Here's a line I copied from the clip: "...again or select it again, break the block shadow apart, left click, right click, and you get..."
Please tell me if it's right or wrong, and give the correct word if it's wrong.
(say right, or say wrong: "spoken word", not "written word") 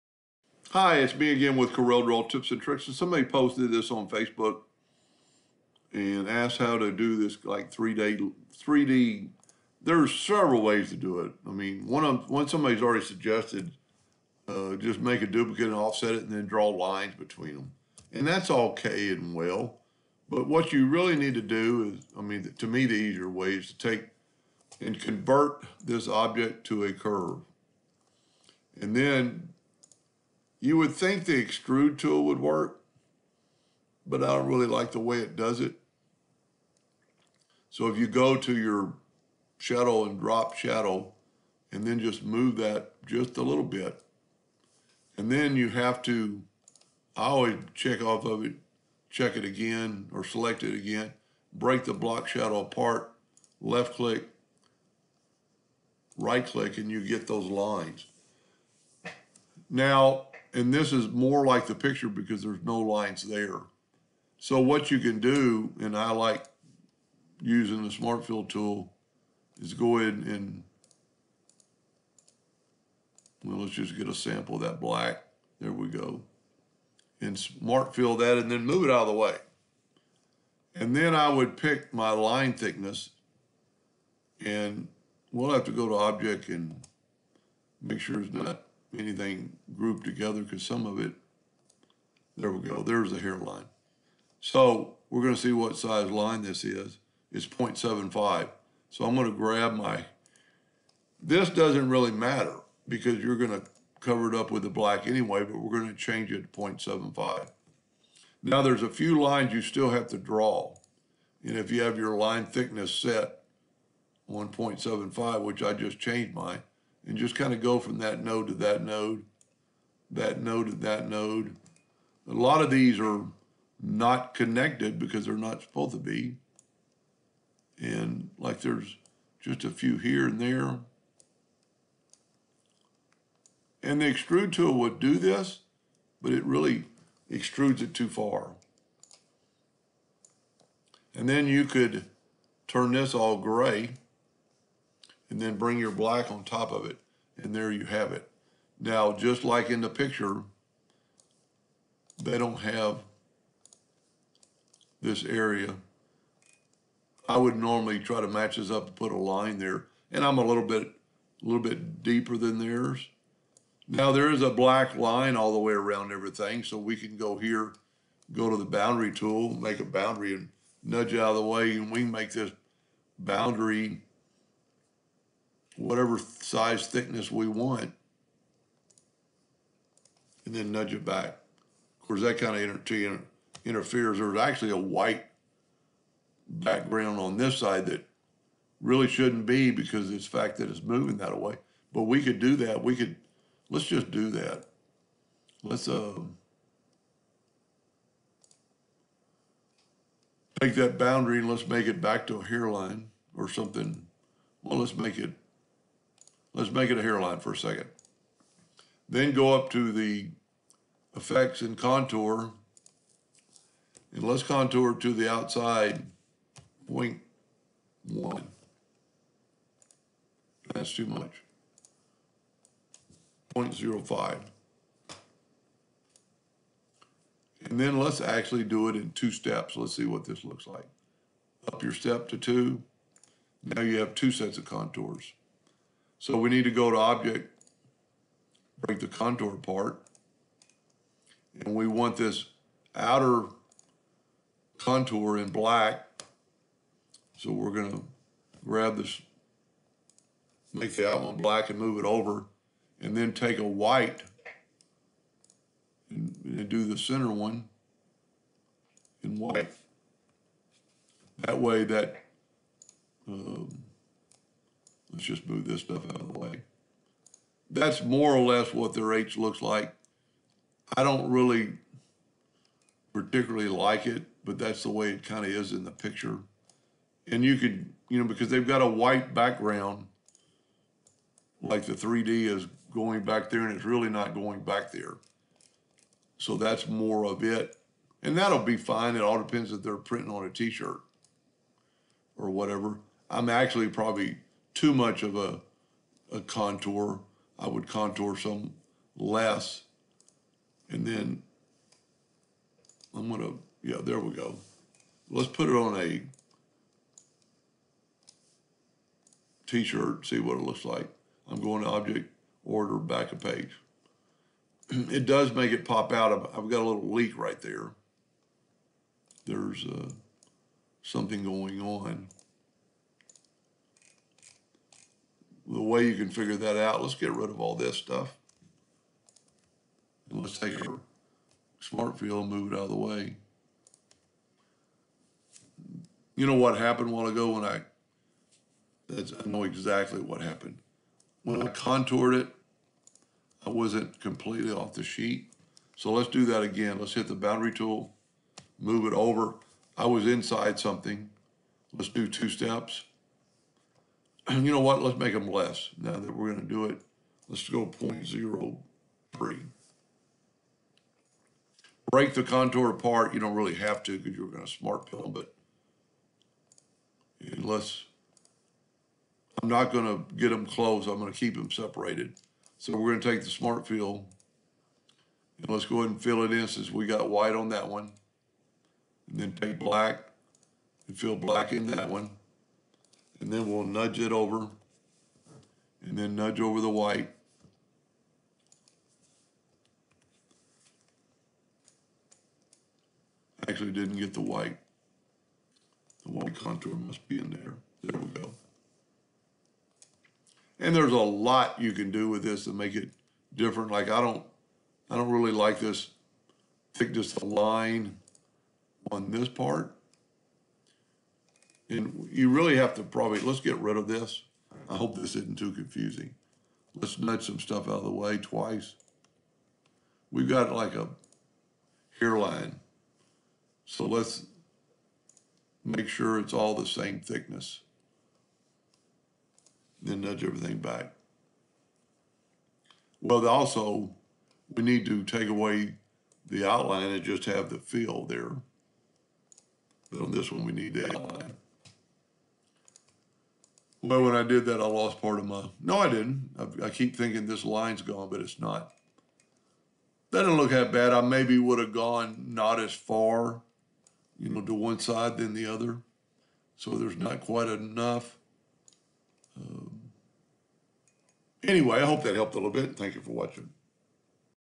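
right.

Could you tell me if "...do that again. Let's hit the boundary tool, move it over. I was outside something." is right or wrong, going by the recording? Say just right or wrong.
wrong.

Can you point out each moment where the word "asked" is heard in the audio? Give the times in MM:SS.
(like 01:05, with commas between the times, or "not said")
00:06.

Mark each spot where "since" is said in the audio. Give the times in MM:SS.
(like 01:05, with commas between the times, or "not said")
06:16.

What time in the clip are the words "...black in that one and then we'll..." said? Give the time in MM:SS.
06:21.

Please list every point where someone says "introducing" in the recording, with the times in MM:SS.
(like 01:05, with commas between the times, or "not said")
not said.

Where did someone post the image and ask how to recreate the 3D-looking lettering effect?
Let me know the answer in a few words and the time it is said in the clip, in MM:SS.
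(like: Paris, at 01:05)
Facebook, at 00:04.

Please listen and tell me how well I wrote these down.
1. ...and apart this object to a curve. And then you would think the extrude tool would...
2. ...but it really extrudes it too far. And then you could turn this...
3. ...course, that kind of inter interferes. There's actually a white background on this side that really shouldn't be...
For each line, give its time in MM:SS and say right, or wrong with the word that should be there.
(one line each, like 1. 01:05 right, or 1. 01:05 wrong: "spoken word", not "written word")
1. 00:24 wrong: "convert", not "apart"
2. 02:16 right
3. 03:02 right.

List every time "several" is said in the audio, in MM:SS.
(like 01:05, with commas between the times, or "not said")
00:10.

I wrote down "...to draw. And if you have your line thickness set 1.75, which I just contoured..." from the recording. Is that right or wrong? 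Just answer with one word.
wrong.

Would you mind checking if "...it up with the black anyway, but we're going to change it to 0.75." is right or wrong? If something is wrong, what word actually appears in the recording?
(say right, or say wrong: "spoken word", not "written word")
right.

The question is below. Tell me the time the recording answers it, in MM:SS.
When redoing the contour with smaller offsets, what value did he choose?
05:57.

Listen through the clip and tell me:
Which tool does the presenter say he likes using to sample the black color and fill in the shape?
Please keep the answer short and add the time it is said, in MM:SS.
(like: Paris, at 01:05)
smart fill tool, at 01:07.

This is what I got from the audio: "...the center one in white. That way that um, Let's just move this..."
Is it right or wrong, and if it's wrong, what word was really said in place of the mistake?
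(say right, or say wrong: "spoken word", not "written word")
right.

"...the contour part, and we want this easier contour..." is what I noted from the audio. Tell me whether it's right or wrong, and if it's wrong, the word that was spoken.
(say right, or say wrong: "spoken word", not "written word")
wrong: "outer", not "easier".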